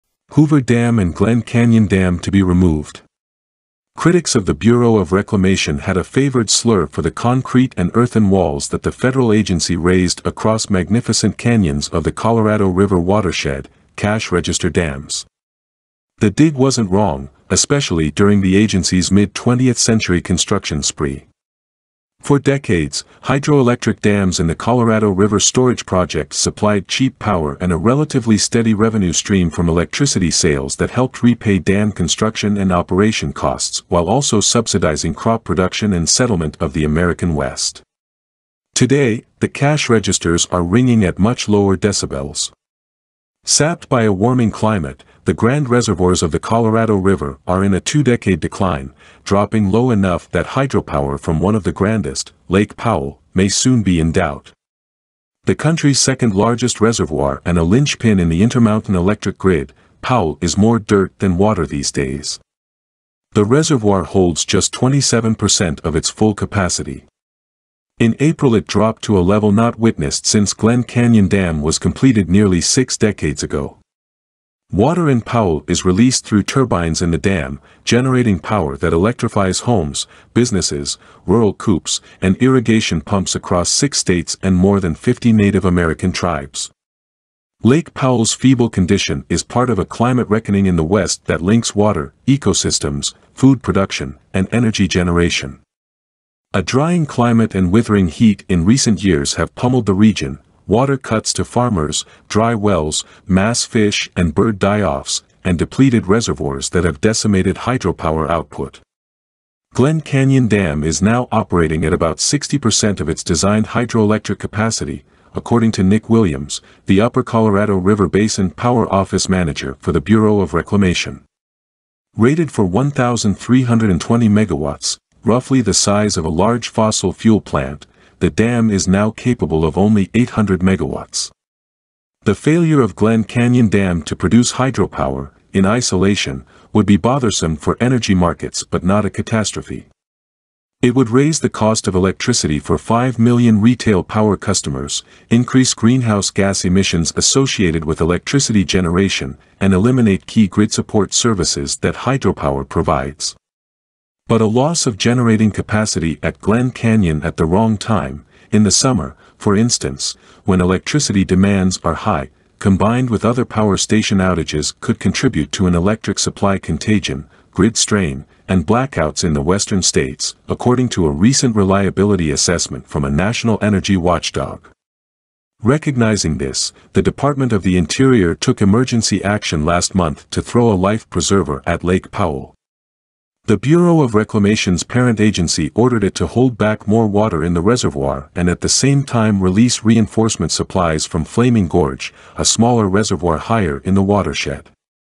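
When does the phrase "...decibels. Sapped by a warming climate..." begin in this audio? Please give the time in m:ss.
0:41.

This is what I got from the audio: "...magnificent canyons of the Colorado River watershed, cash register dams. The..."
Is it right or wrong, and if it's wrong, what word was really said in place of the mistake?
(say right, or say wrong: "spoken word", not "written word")
right.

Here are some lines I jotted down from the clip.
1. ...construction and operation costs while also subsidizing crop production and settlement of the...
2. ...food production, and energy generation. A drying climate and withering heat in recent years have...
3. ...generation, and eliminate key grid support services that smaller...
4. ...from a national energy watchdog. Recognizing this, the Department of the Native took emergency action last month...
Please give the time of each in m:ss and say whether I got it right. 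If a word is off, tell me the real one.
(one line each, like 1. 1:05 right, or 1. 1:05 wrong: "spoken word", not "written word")
1. 0:31 right
2. 1:33 right
3. 2:28 wrong: "hydropower", not "smaller"
4. 2:52 wrong: "Interior", not "Native".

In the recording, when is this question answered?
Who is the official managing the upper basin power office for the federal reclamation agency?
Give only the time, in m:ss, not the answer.
1:55.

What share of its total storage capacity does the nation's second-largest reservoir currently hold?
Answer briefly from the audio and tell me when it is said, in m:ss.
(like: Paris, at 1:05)
27%, at 1:04.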